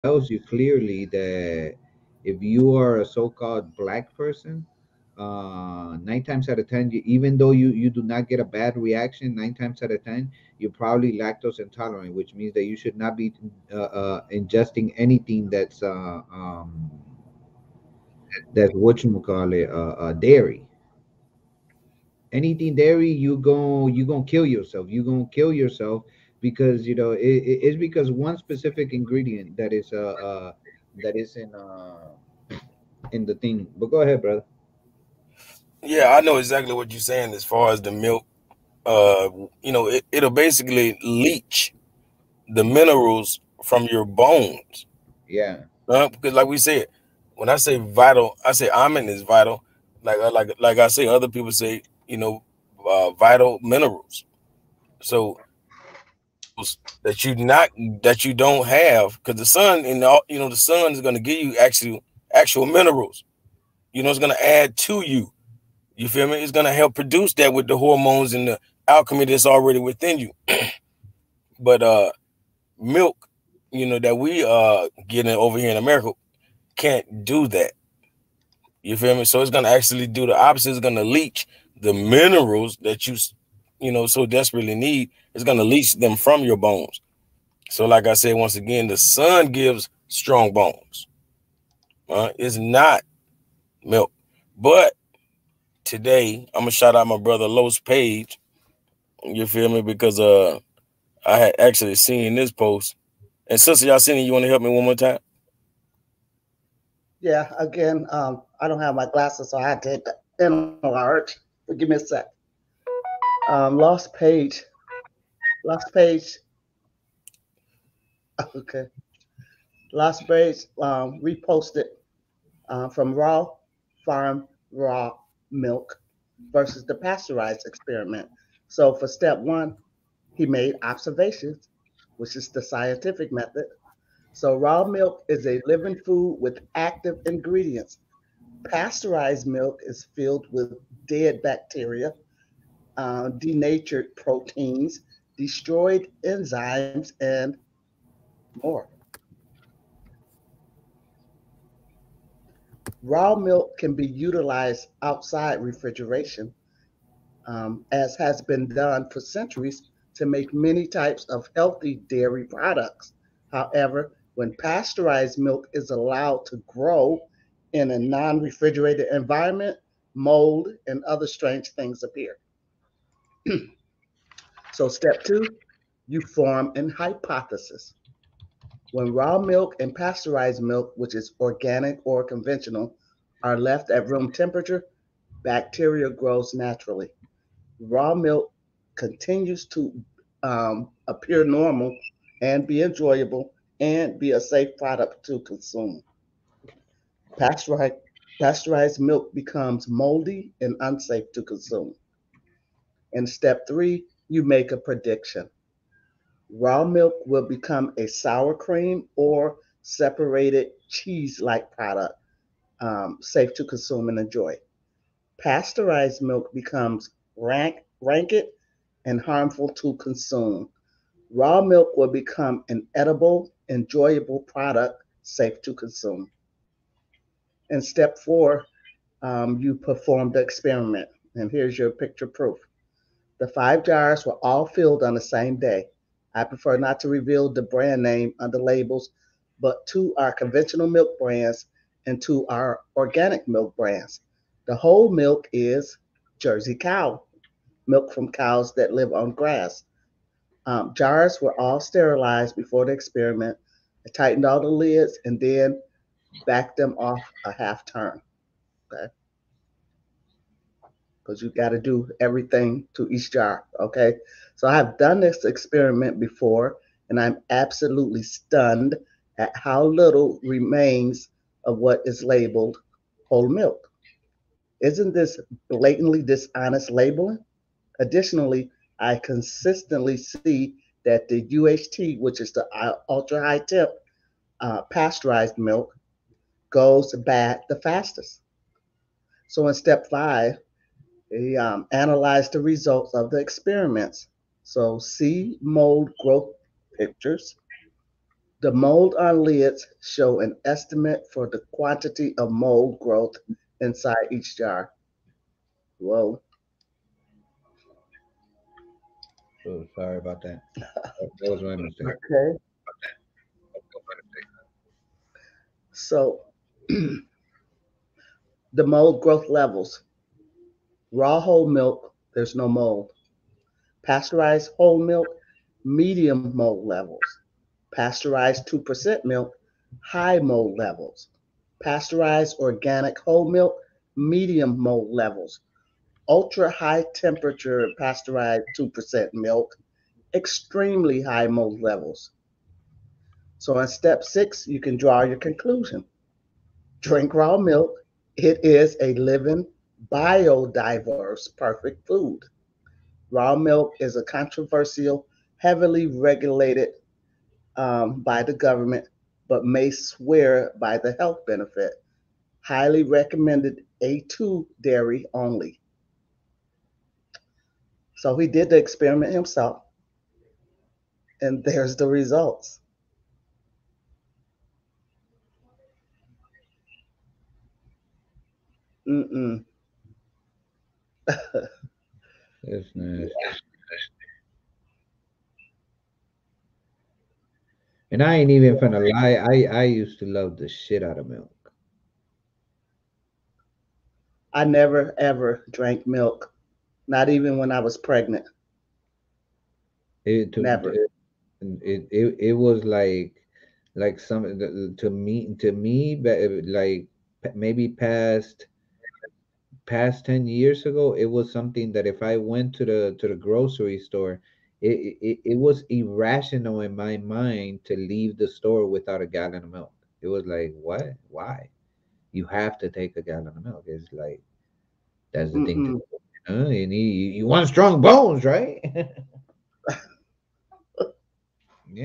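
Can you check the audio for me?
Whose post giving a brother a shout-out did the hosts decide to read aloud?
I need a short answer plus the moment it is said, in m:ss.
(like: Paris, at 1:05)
Los Page, at 1:37.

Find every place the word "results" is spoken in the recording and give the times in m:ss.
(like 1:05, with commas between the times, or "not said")
4:52, 6:12.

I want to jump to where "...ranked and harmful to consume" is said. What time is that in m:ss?
3:37.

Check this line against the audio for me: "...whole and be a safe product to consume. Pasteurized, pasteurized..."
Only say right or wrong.
wrong.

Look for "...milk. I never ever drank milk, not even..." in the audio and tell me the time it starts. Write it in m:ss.
6:31.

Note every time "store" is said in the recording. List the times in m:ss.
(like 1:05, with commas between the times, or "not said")
6:53, 6:58.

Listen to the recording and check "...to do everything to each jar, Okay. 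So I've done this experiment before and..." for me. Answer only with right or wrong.
right.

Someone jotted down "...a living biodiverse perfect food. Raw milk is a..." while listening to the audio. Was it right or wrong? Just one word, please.
right.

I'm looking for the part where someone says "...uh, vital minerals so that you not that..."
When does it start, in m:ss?
0:52.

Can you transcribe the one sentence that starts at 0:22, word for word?
Anything dairy, you go you gonna kill yourself.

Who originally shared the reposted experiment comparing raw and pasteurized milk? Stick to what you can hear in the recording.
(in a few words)
Raw Farm.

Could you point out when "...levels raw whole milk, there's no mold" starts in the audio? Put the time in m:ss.
5:19.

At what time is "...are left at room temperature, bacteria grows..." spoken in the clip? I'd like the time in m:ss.
3:03.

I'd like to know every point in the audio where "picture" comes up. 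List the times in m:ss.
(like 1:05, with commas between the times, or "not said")
3:51, 4:56.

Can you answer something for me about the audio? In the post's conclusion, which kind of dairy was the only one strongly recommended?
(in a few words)
A2 dairy.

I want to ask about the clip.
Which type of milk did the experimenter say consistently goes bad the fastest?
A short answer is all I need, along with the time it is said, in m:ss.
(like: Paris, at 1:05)
UHT, at 4:41.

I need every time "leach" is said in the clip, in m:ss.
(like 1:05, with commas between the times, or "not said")
0:41, 1:21, 1:25.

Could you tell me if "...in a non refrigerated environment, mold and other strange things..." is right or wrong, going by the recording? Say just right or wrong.
right.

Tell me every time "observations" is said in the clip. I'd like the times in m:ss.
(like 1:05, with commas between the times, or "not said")
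2:10.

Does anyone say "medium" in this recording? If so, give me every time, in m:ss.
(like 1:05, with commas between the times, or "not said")
5:25, 5:34.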